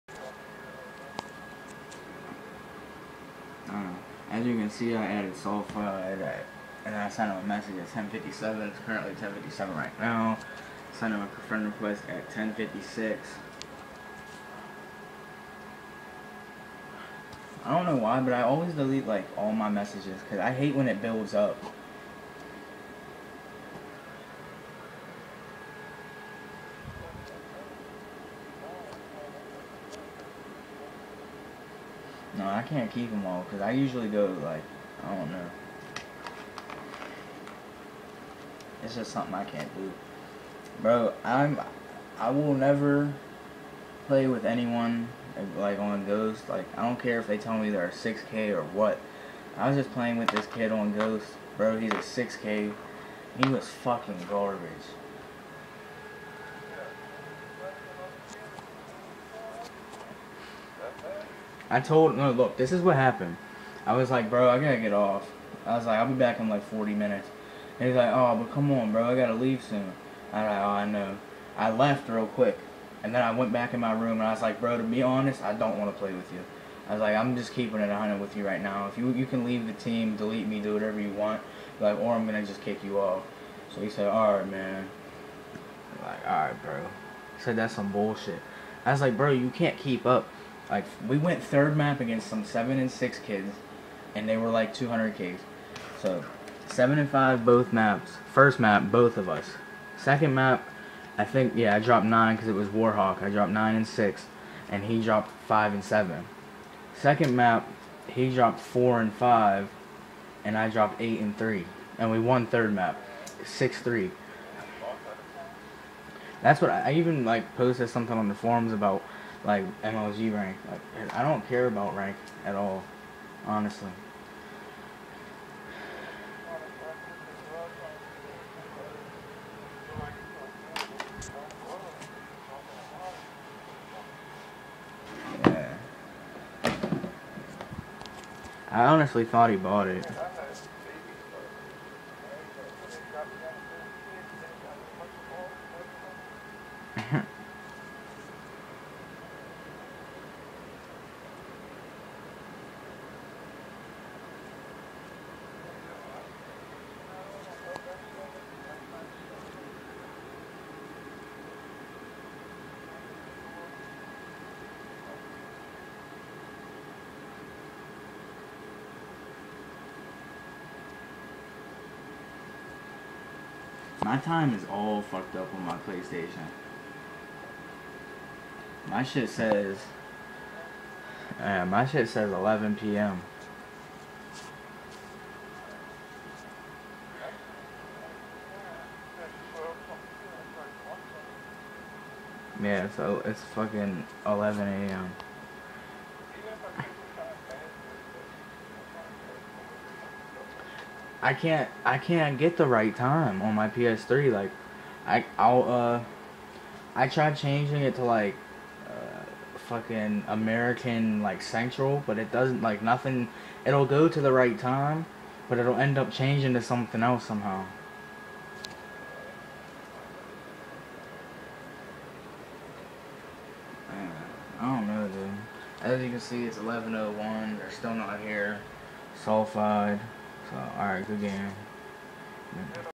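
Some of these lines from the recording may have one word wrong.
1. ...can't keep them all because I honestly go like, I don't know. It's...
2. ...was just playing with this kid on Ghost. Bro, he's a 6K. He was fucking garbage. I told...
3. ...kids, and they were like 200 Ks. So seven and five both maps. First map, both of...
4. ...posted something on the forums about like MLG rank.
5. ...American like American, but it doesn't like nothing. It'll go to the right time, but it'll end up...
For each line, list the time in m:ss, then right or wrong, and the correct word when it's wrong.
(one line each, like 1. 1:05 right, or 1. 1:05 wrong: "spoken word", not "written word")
1. 0:32 wrong: "usually", not "honestly"
2. 0:49 right
3. 1:33 right
4. 1:57 right
5. 3:30 wrong: "Central", not "American".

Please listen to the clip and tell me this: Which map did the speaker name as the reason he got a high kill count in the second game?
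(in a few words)
Warhawk.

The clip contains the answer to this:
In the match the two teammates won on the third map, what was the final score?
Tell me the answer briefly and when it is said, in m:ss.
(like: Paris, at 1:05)
6-3, at 1:53.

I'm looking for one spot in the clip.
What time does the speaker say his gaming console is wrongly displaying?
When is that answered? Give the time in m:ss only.
3:02.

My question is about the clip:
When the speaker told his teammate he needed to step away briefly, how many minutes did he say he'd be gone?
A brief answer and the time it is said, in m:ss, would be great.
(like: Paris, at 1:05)
40 minutes, at 1:06.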